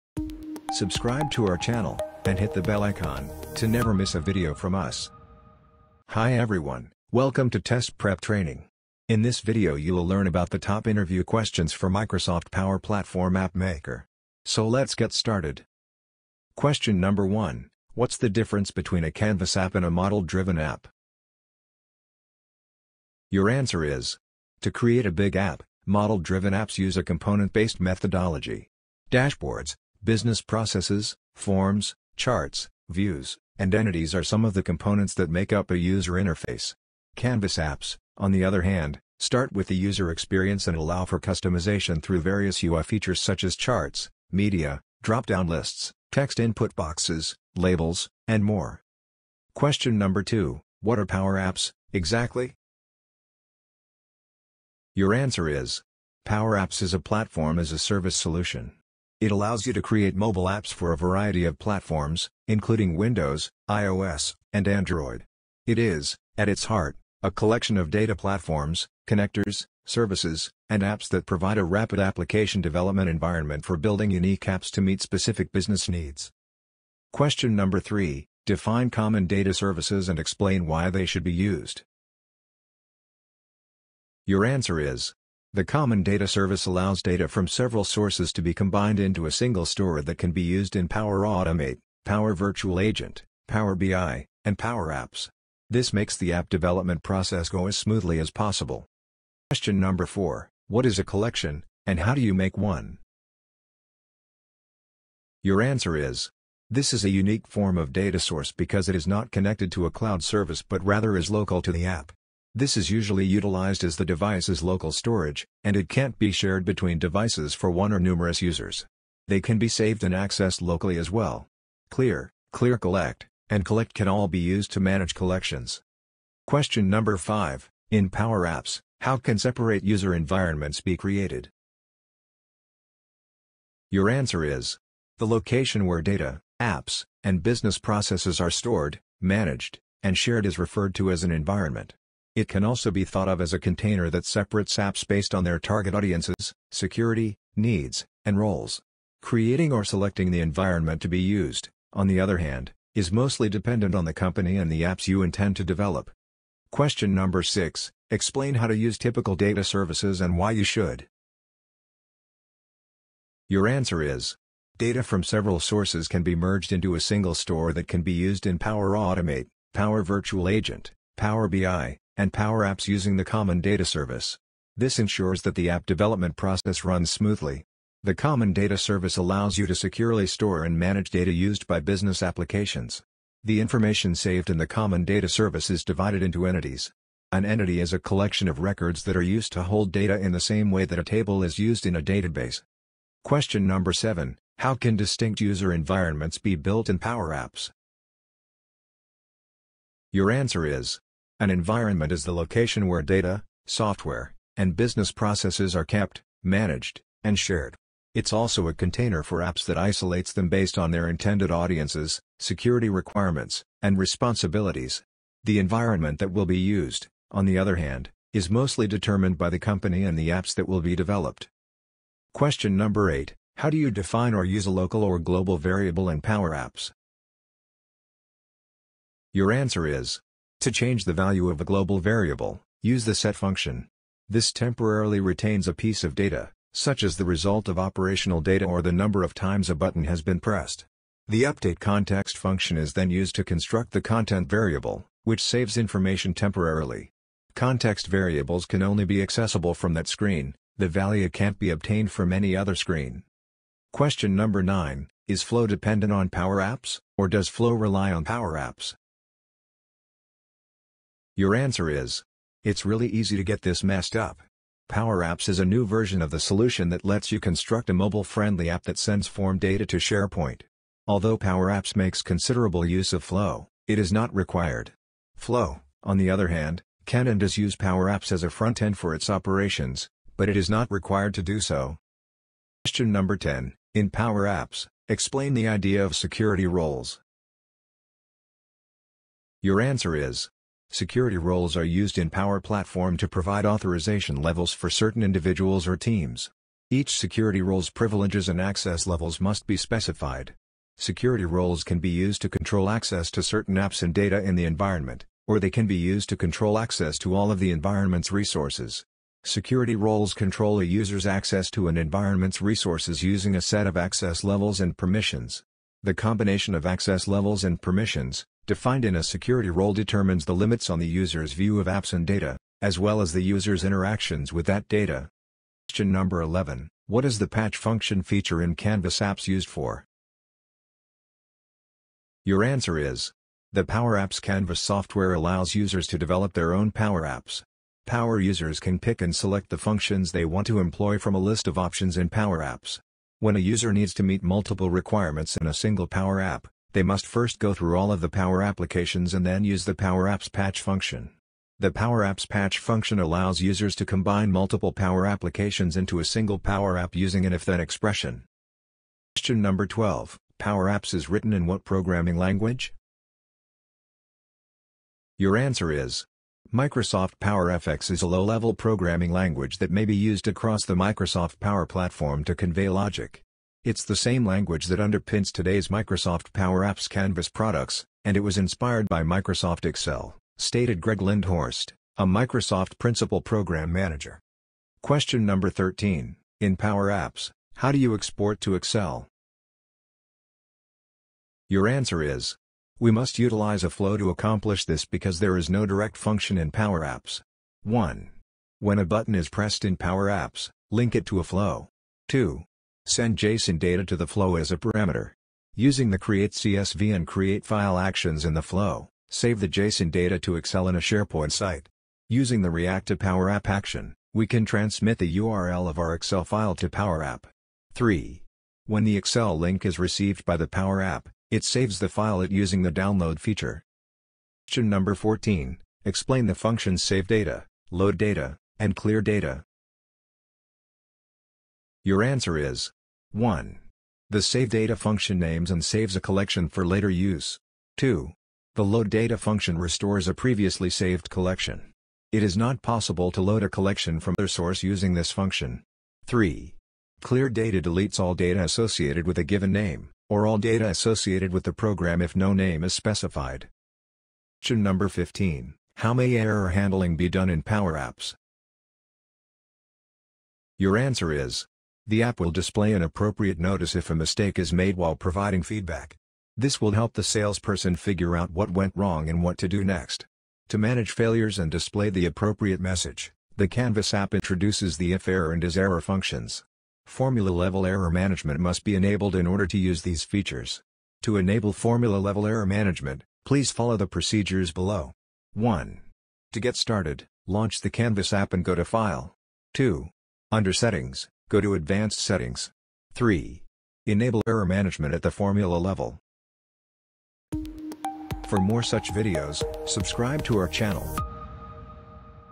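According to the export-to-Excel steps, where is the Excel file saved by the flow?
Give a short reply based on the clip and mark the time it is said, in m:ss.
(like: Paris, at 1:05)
A SharePoint site, at 6:50.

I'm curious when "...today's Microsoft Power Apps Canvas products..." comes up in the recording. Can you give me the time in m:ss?
6:15.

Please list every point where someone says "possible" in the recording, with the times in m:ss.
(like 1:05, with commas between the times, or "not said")
1:38, 7:22.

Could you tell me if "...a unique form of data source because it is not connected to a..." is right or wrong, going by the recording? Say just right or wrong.
right.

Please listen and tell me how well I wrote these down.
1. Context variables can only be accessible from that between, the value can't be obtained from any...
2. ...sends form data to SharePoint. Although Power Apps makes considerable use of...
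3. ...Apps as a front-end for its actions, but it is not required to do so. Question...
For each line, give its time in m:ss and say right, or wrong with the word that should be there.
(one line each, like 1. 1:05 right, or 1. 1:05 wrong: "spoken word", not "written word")
1. 4:07 wrong: "screen", not "between"
2. 4:28 right
3. 4:38 wrong: "operations", not "actions".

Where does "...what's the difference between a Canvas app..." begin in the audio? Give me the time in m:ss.
0:17.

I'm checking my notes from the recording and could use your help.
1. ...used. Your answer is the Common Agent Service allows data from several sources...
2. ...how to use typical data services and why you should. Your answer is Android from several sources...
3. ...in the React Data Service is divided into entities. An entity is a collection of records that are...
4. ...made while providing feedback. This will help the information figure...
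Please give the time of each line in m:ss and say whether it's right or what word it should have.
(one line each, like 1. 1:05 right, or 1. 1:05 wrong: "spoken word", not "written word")
1. 1:21 wrong: "Data", not "Agent"
2. 2:38 wrong: "Data", not "Android"
3. 3:04 wrong: "Common", not "React"
4. 7:44 wrong: "salesperson", not "information".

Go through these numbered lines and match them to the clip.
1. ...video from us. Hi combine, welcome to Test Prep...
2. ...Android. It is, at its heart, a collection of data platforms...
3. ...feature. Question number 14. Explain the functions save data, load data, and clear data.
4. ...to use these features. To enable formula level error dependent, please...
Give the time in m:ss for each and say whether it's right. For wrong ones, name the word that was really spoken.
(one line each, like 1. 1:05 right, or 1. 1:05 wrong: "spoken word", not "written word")
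1. 0:04 wrong: "everyone", not "combine"
2. 1:04 right
3. 7:03 right
4. 7:59 wrong: "management", not "dependent".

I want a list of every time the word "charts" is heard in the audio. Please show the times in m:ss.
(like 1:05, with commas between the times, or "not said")
0:32, 0:43.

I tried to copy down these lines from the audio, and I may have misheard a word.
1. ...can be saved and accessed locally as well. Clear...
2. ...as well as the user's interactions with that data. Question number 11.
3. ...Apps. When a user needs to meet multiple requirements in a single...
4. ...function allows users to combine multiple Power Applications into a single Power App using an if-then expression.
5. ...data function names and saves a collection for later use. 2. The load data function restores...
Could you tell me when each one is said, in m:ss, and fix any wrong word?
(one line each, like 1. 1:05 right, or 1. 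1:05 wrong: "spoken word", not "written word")
1. 1:59 right
2. 5:22 right
3. 5:42 right
4. 5:52 right
5. 7:14 right.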